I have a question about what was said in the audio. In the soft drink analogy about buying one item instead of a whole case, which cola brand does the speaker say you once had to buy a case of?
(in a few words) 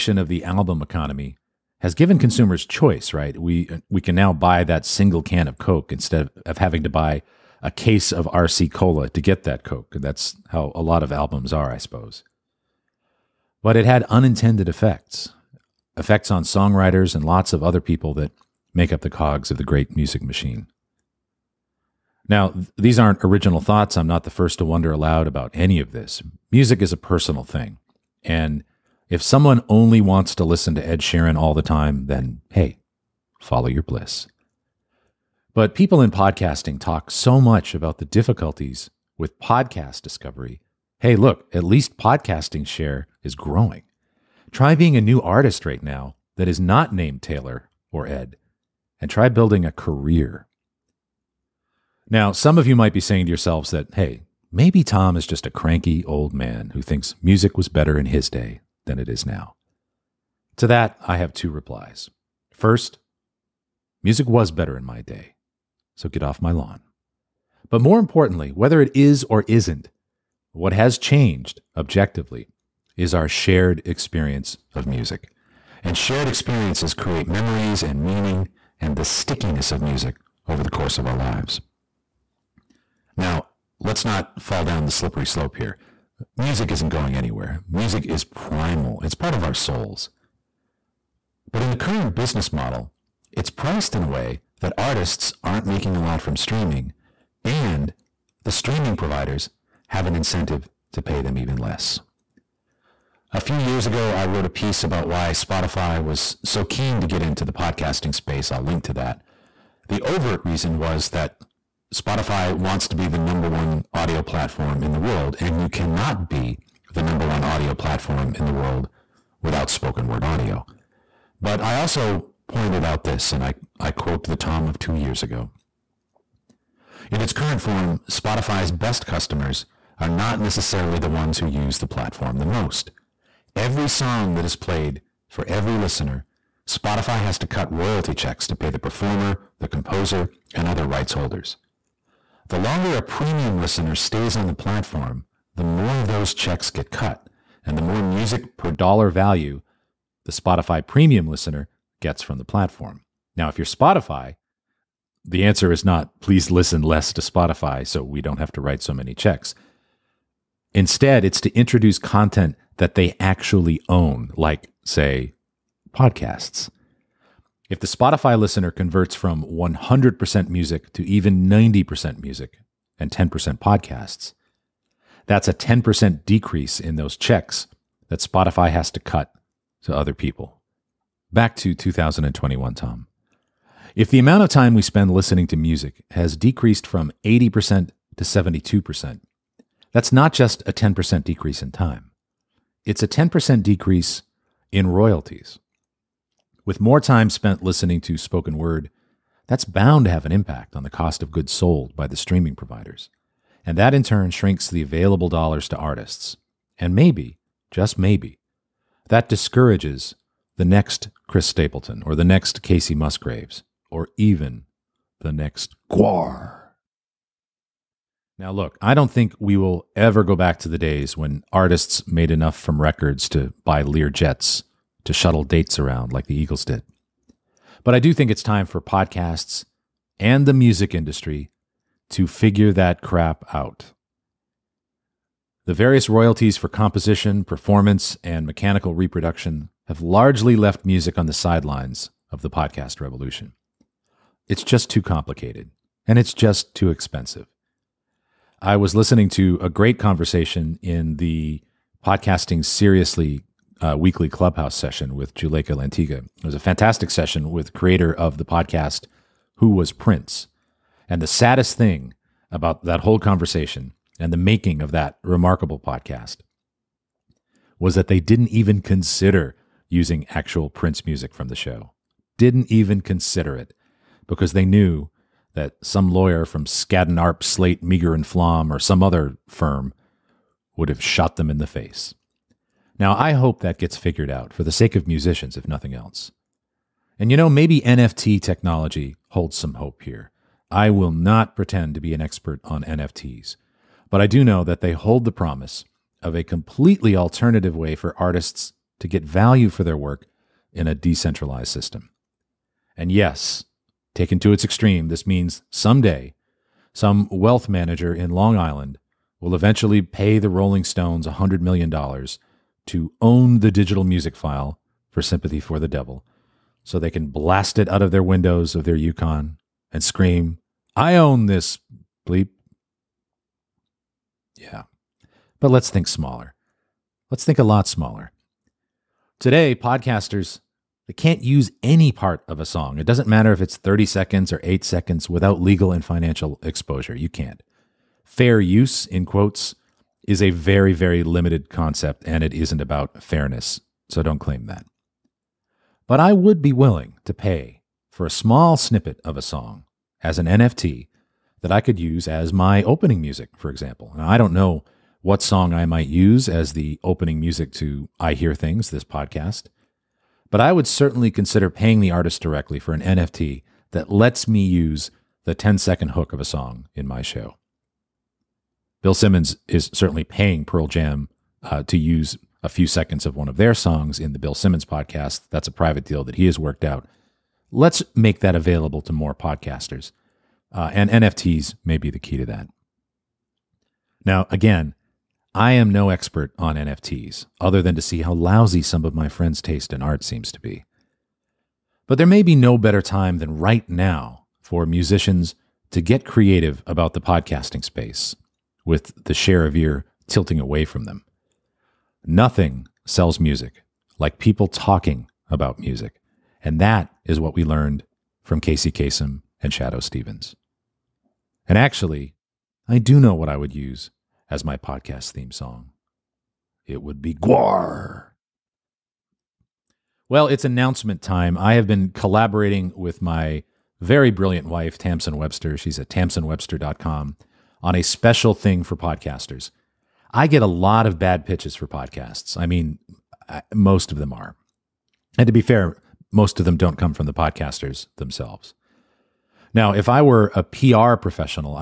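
RC Cola.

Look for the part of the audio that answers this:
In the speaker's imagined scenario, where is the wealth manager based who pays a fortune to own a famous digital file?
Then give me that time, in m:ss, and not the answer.
5:08.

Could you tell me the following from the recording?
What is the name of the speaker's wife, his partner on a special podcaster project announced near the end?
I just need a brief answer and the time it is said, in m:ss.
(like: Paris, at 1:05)
Tamsen Webster, at 7:04.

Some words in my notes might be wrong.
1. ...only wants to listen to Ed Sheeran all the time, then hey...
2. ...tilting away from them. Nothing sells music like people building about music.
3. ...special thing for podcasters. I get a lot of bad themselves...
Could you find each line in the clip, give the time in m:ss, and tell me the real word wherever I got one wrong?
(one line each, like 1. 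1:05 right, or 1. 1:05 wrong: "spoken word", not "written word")
1. 0:29 right
2. 6:40 wrong: "talking", not "building"
3. 7:08 wrong: "pitches", not "themselves".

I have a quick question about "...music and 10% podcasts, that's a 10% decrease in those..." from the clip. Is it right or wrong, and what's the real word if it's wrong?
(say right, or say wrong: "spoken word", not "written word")
right.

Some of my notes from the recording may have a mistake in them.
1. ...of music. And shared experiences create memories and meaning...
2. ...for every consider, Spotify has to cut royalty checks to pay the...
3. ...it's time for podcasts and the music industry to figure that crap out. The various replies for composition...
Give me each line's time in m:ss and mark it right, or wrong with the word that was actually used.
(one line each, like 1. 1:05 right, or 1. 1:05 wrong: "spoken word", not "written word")
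1. 1:14 right
2. 2:15 wrong: "listener", not "consider"
3. 3:48 wrong: "royalties", not "replies".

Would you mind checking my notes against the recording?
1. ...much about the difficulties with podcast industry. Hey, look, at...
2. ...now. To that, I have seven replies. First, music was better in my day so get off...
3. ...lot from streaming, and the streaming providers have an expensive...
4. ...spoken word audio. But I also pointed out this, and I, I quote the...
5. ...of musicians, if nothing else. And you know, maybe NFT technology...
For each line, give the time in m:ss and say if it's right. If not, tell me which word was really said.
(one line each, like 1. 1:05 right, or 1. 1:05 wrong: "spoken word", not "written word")
1. 0:37 wrong: "discovery", not "industry"
2. 0:59 wrong: "two", not "seven"
3. 1:36 wrong: "incentive", not "expensive"
4. 1:59 right
5. 4:44 right.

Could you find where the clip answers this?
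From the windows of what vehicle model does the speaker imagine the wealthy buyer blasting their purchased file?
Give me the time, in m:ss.
5:18.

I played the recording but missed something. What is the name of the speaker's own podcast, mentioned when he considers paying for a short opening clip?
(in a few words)
I Hear Things.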